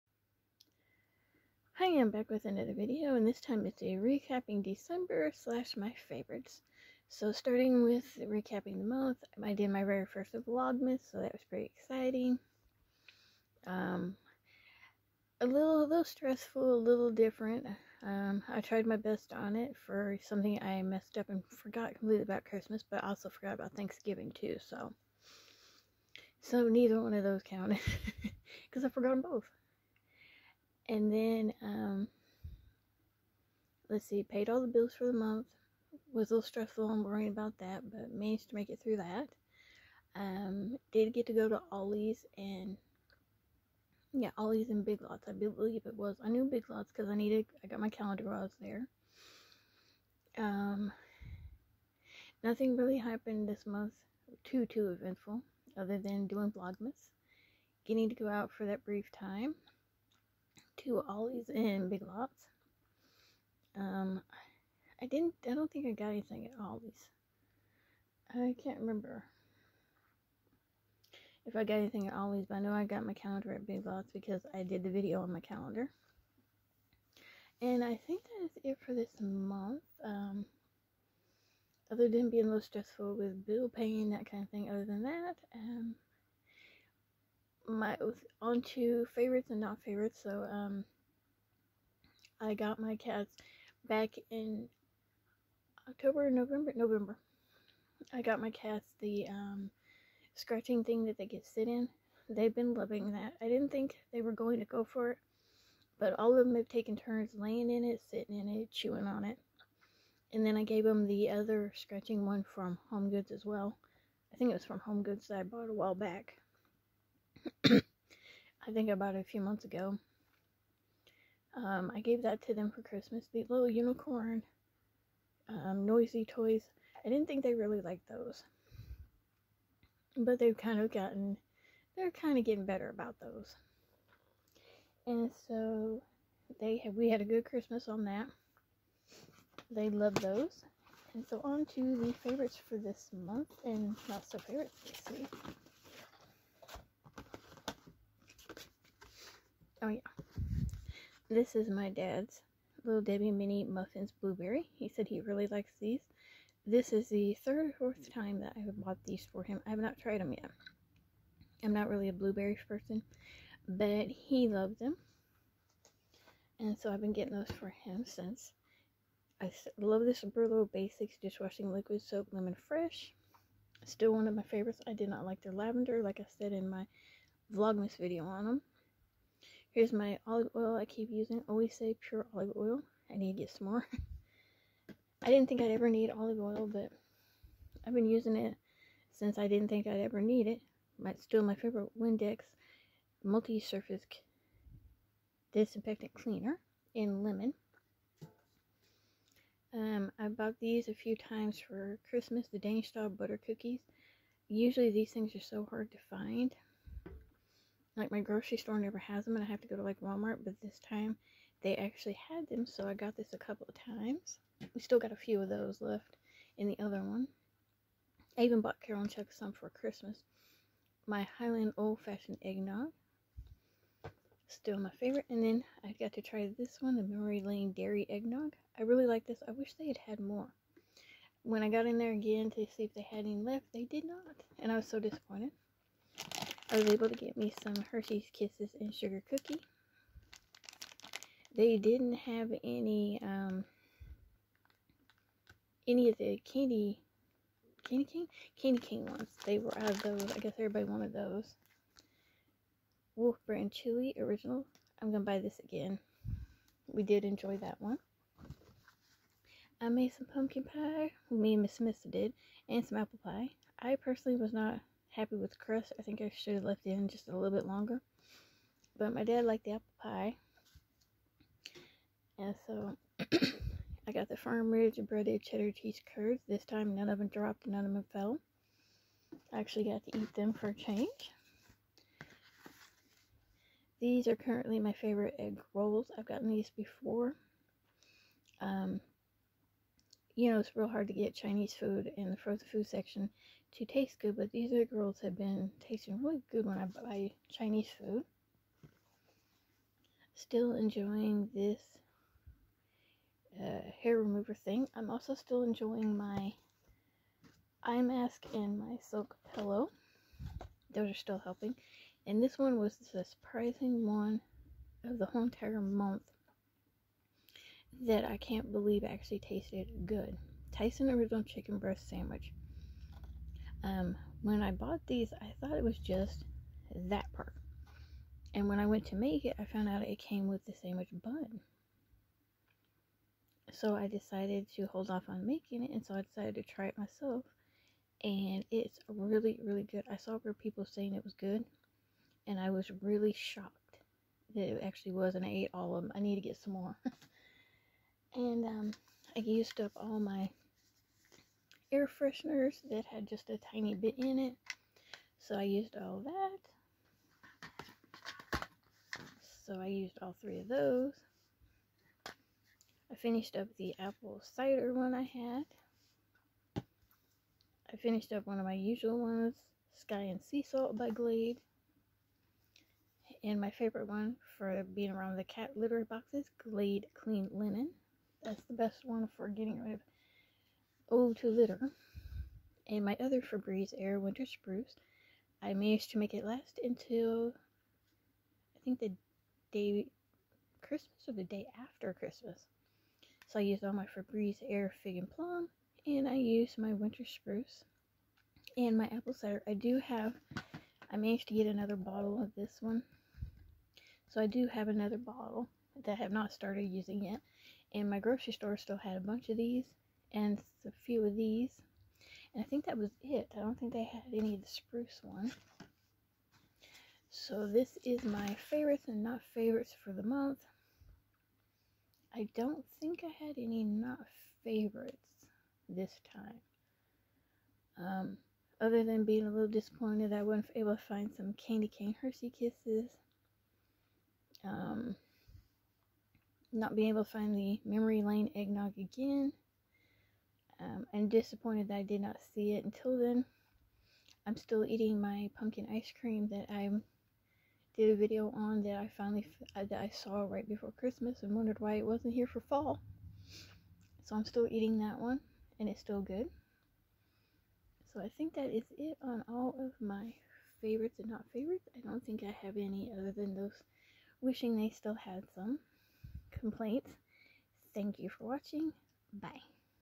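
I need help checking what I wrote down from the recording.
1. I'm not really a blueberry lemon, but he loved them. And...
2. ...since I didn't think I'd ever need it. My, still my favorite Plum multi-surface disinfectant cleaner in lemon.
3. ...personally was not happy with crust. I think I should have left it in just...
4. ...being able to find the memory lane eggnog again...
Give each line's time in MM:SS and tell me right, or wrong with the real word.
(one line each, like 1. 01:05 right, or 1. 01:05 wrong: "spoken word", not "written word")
1. 02:41 wrong: "person", not "lemon"
2. 03:09 wrong: "Windex", not "Plum"
3. 04:23 right
4. 07:16 right.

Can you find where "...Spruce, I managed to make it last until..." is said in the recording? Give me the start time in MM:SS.
06:24.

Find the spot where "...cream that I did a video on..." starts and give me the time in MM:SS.
07:26.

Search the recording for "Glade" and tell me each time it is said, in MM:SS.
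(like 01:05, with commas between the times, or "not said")
06:11, 06:16.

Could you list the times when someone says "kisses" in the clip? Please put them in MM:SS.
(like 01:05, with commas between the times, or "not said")
03:58, 07:12.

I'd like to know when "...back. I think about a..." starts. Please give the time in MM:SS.
01:55.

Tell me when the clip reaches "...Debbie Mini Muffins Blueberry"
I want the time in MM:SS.
02:33.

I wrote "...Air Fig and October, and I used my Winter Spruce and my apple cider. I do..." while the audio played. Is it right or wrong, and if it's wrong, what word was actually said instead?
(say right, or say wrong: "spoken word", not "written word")
wrong: "Plum", not "October".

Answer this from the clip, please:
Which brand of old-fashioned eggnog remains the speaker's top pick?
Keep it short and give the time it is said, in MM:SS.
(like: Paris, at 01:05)
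Hiland, at 03:41.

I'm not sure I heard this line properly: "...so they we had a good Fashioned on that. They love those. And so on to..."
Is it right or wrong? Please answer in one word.
wrong.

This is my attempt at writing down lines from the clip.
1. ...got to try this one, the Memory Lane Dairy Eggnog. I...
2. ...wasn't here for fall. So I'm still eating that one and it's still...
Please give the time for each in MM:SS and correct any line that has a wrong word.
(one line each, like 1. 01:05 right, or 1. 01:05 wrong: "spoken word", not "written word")
1. 03:45 right
2. 07:32 right.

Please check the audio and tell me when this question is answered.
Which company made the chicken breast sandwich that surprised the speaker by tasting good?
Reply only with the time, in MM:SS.
05:20.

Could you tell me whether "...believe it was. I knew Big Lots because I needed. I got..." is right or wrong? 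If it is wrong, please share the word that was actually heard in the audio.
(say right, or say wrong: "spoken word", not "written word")
right.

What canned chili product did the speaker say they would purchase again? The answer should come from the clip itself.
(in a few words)
Wolf Brand Chili Original.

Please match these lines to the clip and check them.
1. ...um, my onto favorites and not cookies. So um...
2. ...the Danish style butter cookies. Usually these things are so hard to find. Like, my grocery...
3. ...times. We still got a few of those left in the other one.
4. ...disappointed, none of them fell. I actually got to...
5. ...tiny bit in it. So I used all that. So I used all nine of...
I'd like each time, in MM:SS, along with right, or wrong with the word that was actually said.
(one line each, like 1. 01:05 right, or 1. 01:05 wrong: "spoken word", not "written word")
1. 01:25 wrong: "favorites", not "cookies"
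2. 03:22 right
3. 03:33 right
4. 04:37 wrong: "dropped", not "disappointed"
5. 05:53 wrong: "three", not "nine".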